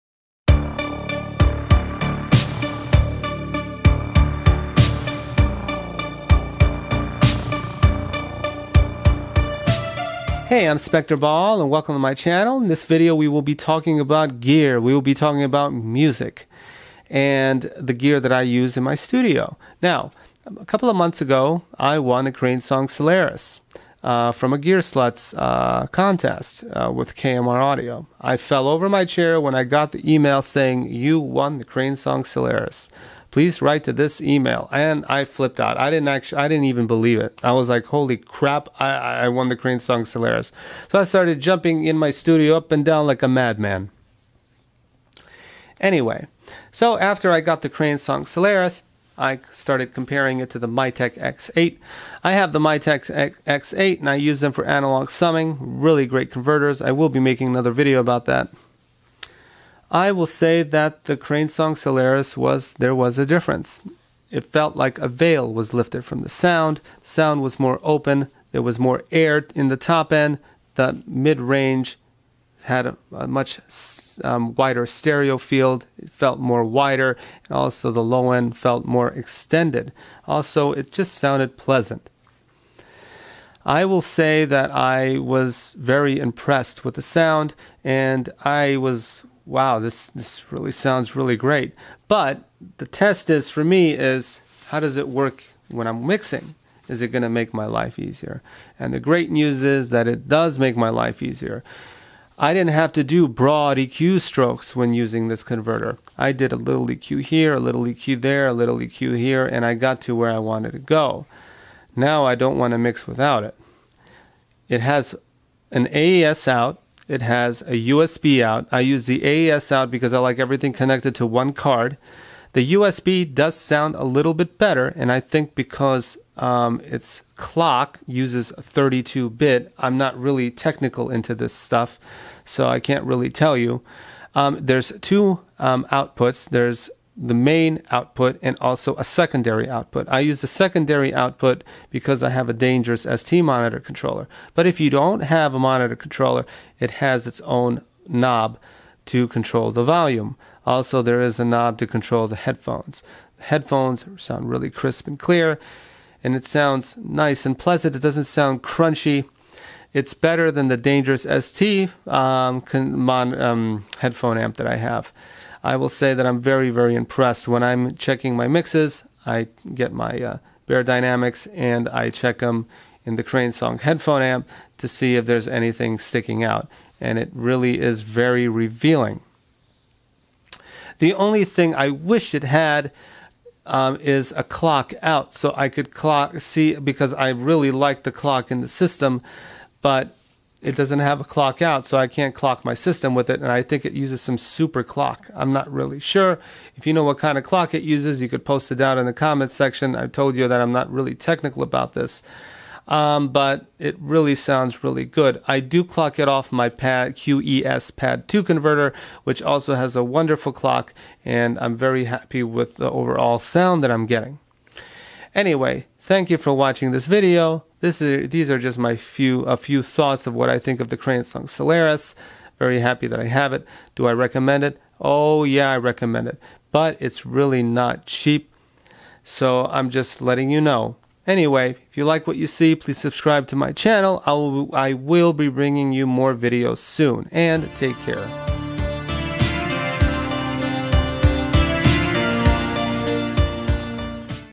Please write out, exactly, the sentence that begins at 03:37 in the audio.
This is, these are just my few a few thoughts of what I think of the Crane song Solaris.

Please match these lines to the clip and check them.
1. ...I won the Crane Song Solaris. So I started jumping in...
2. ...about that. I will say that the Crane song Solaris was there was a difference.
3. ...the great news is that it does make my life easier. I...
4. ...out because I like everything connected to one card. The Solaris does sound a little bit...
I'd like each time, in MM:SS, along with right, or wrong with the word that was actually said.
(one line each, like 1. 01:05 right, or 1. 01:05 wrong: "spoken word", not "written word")
1. 00:38 right
2. 00:57 right
3. 01:38 right
4. 01:59 wrong: "USB", not "Solaris".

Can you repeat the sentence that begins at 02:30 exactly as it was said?
Also, there is a knob to control the headphones.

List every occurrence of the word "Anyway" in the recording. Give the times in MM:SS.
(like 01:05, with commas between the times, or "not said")
00:45, 03:35, 03:51.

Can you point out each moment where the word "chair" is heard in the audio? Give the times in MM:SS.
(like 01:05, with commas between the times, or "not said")
00:29.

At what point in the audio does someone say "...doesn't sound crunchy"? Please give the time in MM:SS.
02:38.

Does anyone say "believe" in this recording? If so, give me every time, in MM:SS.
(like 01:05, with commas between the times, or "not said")
00:36.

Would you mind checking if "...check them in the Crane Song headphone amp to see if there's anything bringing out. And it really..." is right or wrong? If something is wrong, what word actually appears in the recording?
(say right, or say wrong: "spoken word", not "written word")
wrong: "sticking", not "bringing".